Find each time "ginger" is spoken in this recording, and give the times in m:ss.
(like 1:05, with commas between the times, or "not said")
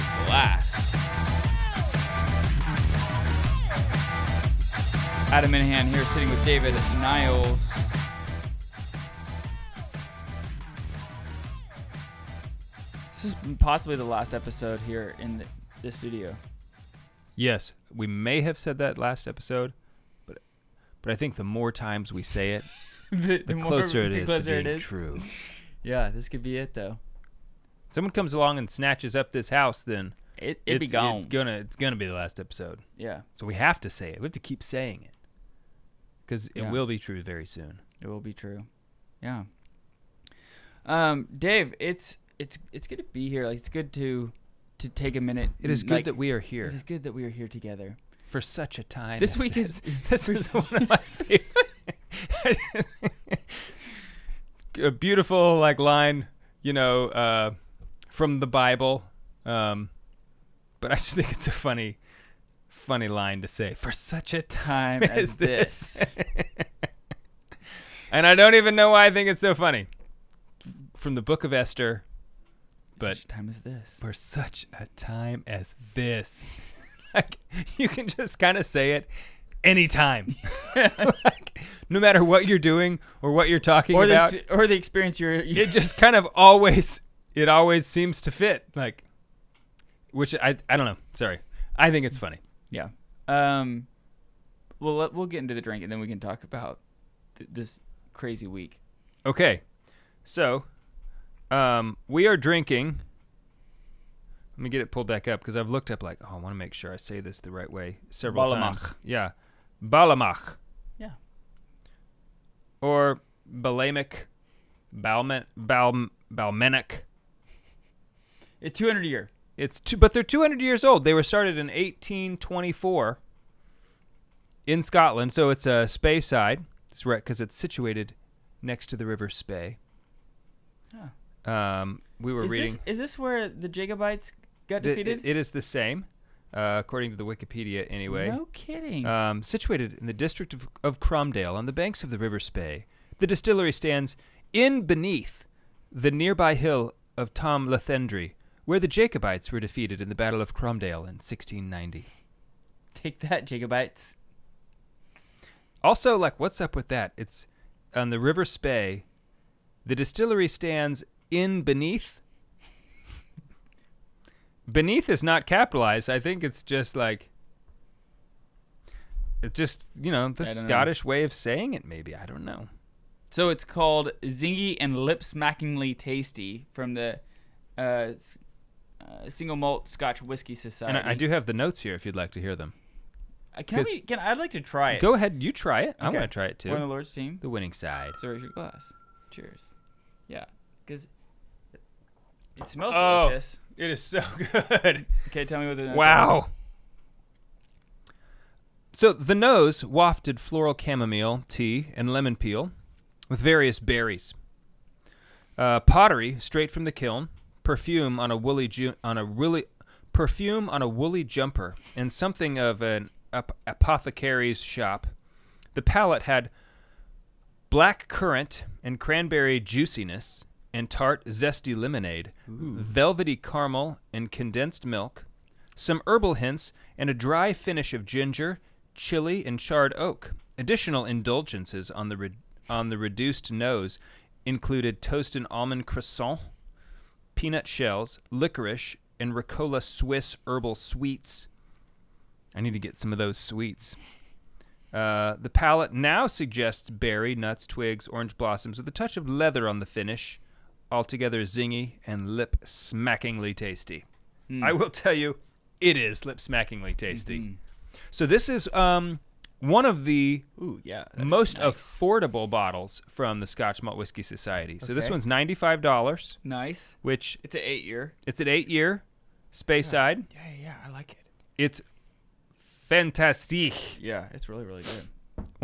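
3:48.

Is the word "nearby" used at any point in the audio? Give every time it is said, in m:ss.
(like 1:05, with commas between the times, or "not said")
2:26.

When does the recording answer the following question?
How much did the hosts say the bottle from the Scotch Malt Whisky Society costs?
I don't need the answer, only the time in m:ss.
4:25.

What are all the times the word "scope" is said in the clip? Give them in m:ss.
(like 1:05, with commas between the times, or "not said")
not said.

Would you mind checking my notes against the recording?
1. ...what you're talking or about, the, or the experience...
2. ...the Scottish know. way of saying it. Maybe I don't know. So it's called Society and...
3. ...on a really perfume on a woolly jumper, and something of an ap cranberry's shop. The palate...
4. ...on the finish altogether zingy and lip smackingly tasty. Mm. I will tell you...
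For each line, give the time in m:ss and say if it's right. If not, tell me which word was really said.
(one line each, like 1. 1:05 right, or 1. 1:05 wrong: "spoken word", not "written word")
1. 1:23 right
2. 2:50 wrong: "Zingy", not "Society"
3. 3:29 wrong: "apothecary", not "cranberry"
4. 4:09 right.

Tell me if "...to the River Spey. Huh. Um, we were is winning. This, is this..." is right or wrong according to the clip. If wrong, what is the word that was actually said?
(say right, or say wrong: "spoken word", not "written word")
wrong: "reading", not "winning".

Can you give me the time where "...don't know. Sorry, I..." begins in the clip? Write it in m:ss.
1:30.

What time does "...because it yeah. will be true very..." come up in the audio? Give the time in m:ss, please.
0:36.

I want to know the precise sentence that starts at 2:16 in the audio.
Uh, according to the Wikipedia, anyway.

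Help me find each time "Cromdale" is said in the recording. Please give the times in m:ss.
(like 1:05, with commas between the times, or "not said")
2:20, 2:30.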